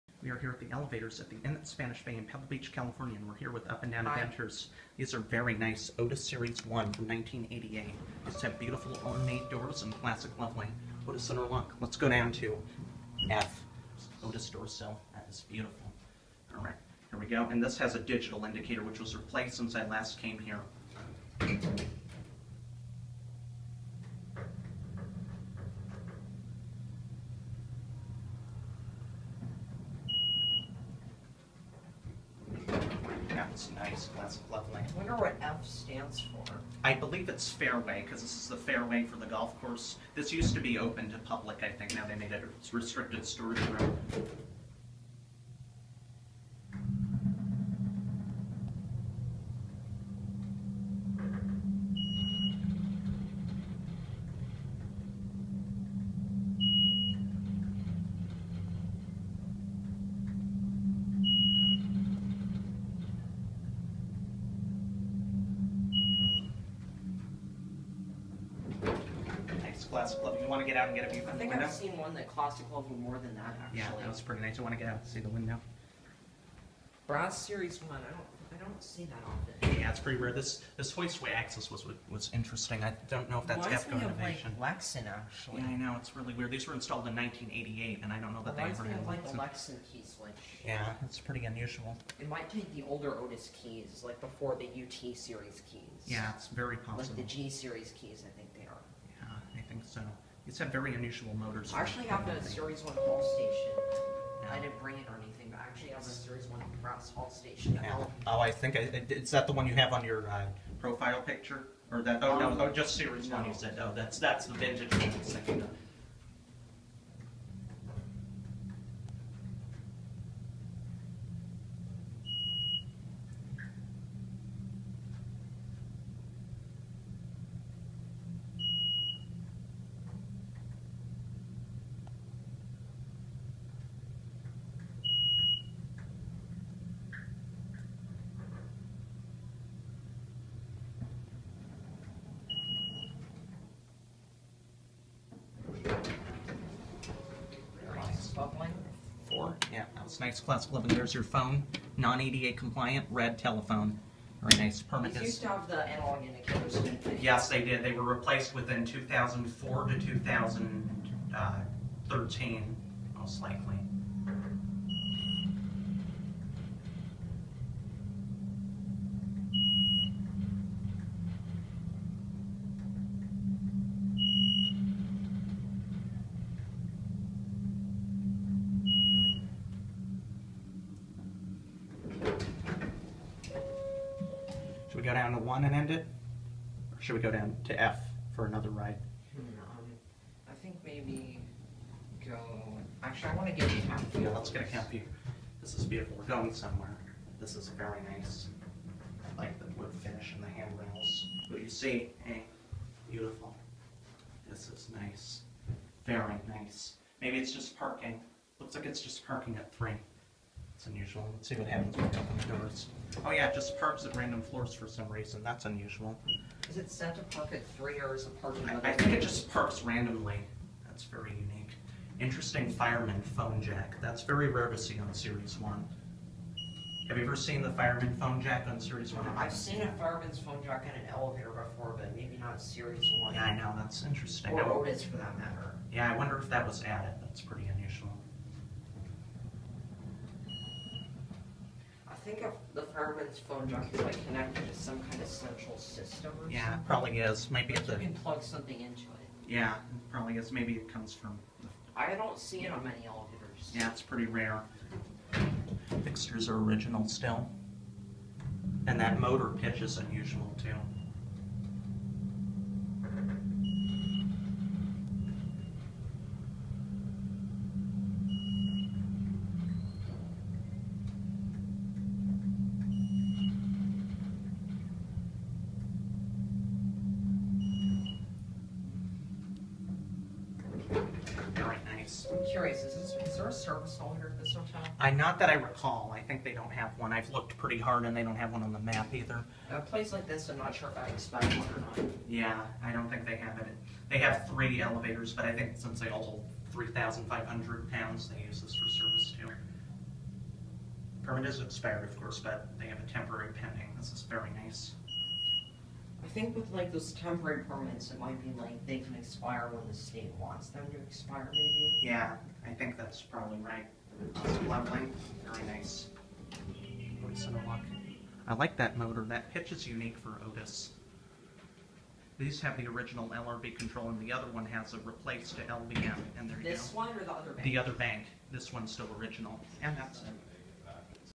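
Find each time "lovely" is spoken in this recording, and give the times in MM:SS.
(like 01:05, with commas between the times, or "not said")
00:34, 05:14.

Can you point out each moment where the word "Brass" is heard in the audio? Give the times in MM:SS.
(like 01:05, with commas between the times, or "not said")
01:17, 01:46.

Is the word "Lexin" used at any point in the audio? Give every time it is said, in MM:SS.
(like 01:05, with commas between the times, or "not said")
01:24, 01:29.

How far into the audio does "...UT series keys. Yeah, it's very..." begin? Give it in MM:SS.
01:34.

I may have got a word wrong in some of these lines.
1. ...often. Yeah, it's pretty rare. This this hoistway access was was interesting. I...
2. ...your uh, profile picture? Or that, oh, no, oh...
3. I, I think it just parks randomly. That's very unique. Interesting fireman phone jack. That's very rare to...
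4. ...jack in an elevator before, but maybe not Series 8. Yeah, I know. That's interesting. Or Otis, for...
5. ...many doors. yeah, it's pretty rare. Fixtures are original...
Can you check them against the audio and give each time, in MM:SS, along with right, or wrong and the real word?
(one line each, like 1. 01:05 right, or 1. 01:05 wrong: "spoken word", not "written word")
1. 01:19 right
2. 01:50 right
3. 03:38 right
4. 03:50 wrong: "1", not "8"
5. 04:12 wrong: "elevators", not "doors".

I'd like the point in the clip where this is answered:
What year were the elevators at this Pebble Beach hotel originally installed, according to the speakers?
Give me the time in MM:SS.
01:26.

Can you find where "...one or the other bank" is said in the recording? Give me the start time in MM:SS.
05:26.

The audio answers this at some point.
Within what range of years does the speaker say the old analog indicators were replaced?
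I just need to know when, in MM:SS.
02:38.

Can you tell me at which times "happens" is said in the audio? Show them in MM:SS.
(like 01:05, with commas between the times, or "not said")
03:31.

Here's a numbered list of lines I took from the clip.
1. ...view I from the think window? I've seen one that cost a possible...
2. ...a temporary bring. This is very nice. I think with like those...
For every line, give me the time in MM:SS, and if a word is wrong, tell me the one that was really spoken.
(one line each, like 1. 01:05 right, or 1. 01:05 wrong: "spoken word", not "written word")
1. 01:11 wrong: "couple", not "possible"
2. 05:02 wrong: "pending", not "bring".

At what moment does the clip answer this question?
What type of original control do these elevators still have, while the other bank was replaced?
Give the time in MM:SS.
05:22.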